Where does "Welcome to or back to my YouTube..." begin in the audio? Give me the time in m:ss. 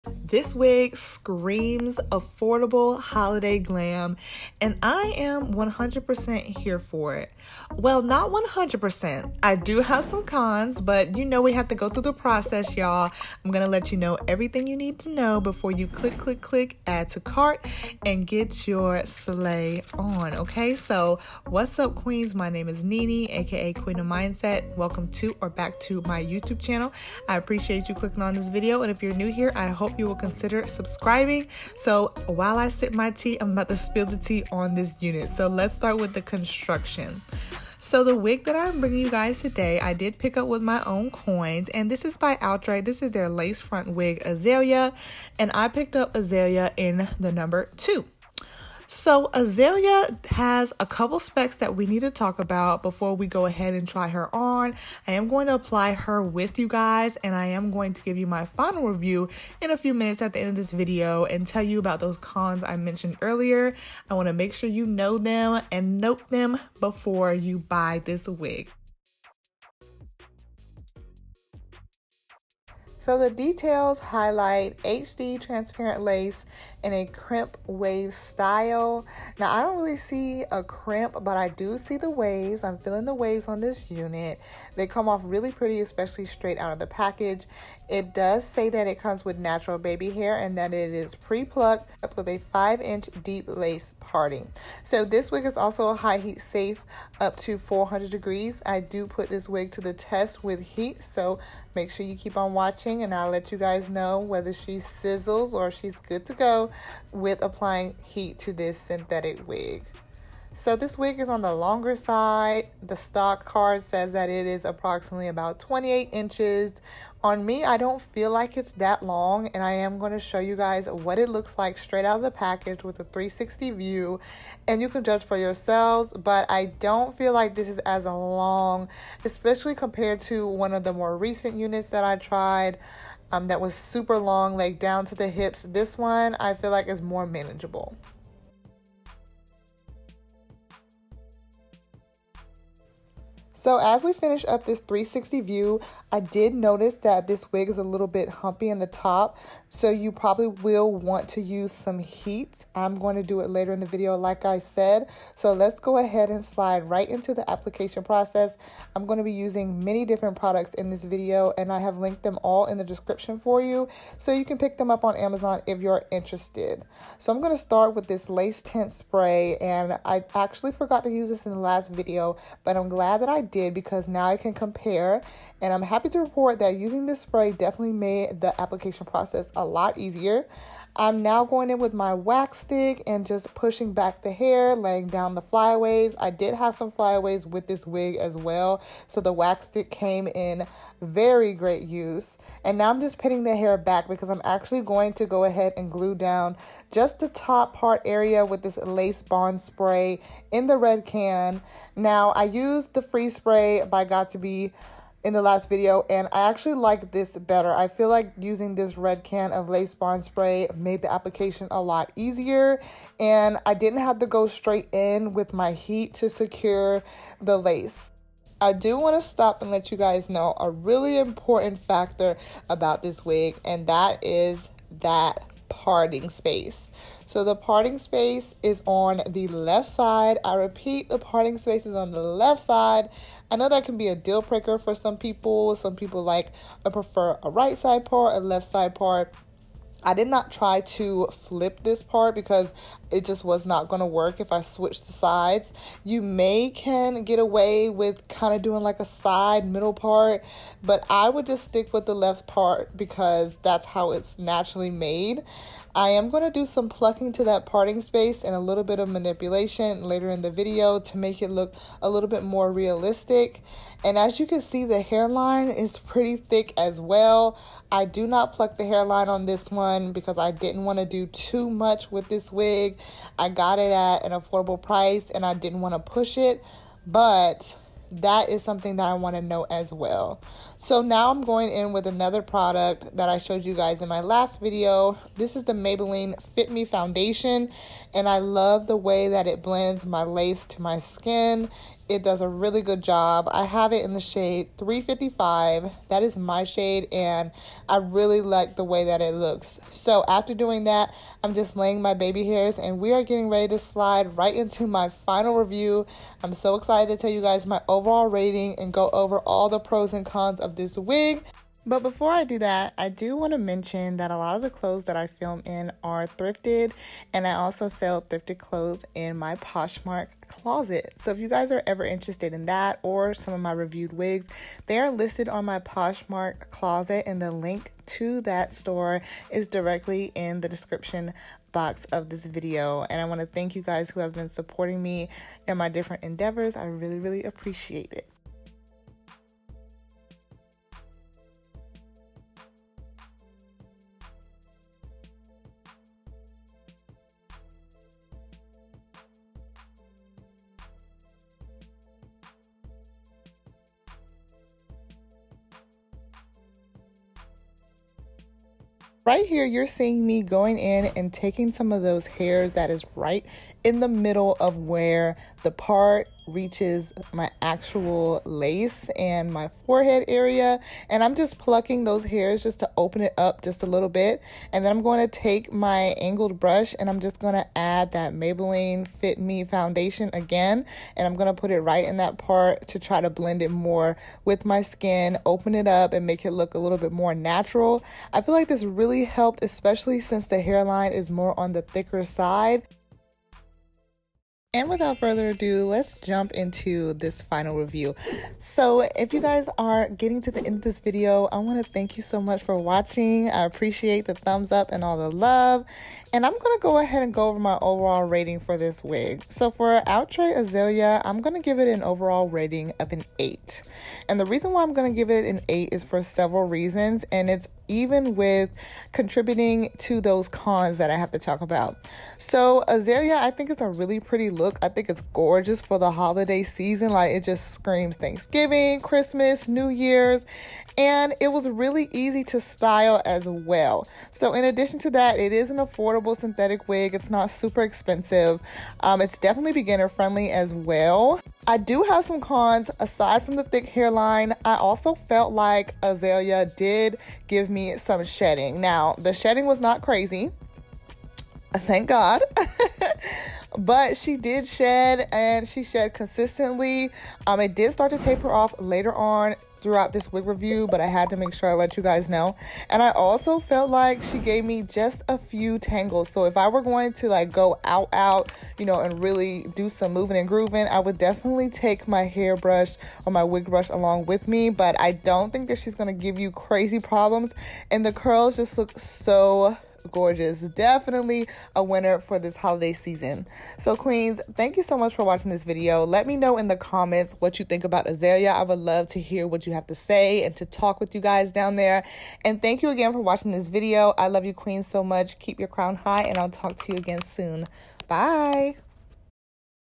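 0:24.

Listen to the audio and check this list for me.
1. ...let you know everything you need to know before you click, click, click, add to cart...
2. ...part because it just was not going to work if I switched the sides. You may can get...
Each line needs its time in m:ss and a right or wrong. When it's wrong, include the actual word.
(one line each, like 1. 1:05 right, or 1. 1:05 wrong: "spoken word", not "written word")
1. 0:13 right
2. 4:02 right.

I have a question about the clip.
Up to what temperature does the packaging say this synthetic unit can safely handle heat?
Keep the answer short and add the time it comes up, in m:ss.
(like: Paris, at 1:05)
400 degrees, at 1:37.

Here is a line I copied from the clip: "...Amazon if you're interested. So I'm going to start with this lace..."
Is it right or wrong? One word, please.
right.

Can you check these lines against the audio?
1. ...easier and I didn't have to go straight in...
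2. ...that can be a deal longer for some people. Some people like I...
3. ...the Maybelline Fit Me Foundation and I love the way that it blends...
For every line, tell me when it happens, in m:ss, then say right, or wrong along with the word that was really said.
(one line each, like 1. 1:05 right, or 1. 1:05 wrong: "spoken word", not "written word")
1. 3:32 right
2. 3:53 wrong: "breaker", not "longer"
3. 4:45 right.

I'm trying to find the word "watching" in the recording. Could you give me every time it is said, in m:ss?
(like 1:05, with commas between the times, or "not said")
1:42, 6:42, 8:05, 8:13.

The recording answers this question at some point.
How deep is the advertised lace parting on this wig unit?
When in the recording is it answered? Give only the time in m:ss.
1:32.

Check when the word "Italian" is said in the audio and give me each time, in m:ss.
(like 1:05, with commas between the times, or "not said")
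not said.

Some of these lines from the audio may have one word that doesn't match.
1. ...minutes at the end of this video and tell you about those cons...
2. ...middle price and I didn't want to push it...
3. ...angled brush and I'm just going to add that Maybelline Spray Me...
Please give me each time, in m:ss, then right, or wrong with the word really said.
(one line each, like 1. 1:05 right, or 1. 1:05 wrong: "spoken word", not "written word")
1. 0:59 right
2. 4:34 wrong: "affordable", not "middle"
3. 6:16 wrong: "Fit", not "Spray".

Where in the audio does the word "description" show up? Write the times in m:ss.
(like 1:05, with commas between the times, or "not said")
2:42, 5:30.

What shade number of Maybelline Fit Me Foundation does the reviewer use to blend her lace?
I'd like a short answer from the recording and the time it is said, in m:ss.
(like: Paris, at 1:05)
355, at 4:54.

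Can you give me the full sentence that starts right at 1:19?
Now, I don't really see a crimp, but I do see the waves.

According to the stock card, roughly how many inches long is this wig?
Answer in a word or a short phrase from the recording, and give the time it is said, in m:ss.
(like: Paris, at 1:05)
28 inches, at 1:55.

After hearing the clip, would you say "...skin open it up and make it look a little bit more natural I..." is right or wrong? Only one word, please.
right.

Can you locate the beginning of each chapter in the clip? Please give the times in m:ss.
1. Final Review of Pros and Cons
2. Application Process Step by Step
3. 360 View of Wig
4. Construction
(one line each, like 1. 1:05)
1. 6:36
2. 2:00
3. 2:17
4. 0:38.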